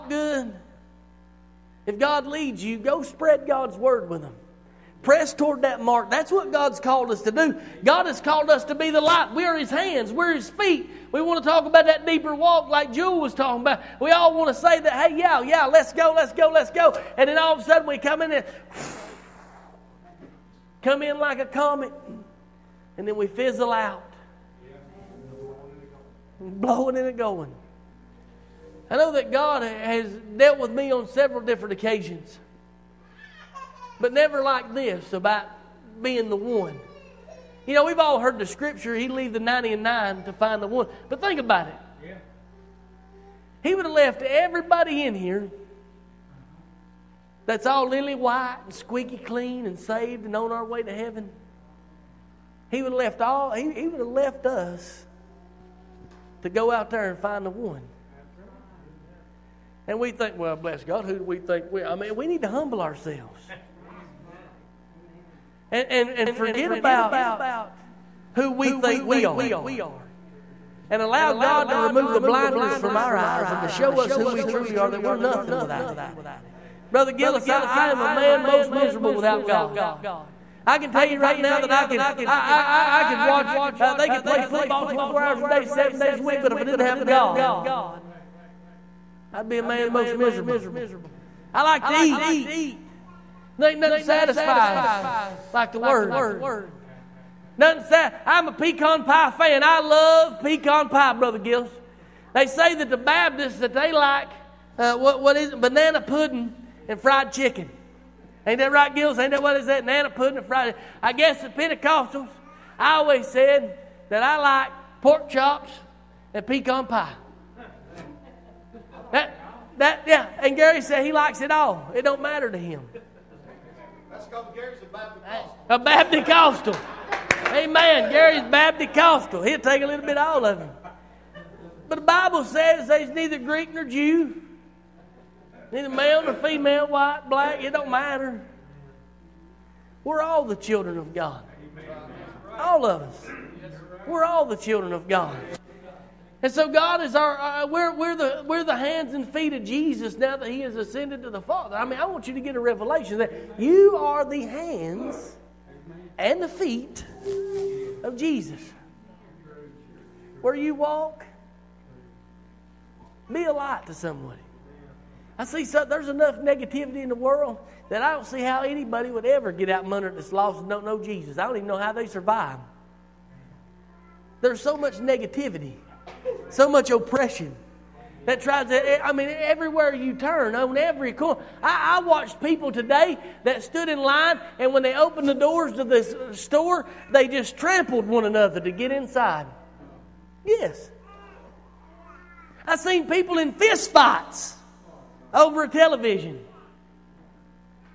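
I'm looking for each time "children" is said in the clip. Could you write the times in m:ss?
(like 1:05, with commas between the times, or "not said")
2:20, 2:24.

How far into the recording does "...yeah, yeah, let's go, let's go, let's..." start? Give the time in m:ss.
0:15.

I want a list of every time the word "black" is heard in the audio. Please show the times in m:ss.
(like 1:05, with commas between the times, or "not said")
2:17.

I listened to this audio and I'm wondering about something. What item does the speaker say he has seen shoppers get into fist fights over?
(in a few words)
television.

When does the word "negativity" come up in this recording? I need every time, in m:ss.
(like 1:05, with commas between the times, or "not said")
2:46, 2:54.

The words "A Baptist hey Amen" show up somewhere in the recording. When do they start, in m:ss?
2:05.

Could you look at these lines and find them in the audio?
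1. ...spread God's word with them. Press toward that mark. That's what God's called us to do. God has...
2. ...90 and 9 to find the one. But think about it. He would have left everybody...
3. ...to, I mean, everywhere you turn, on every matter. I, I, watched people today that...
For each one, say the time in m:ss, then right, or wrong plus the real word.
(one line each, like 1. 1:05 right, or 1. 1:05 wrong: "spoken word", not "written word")
1. 0:03 right
2. 0:39 right
3. 2:58 wrong: "corner", not "matter".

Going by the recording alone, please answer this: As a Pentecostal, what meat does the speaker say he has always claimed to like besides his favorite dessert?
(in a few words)
pork chops.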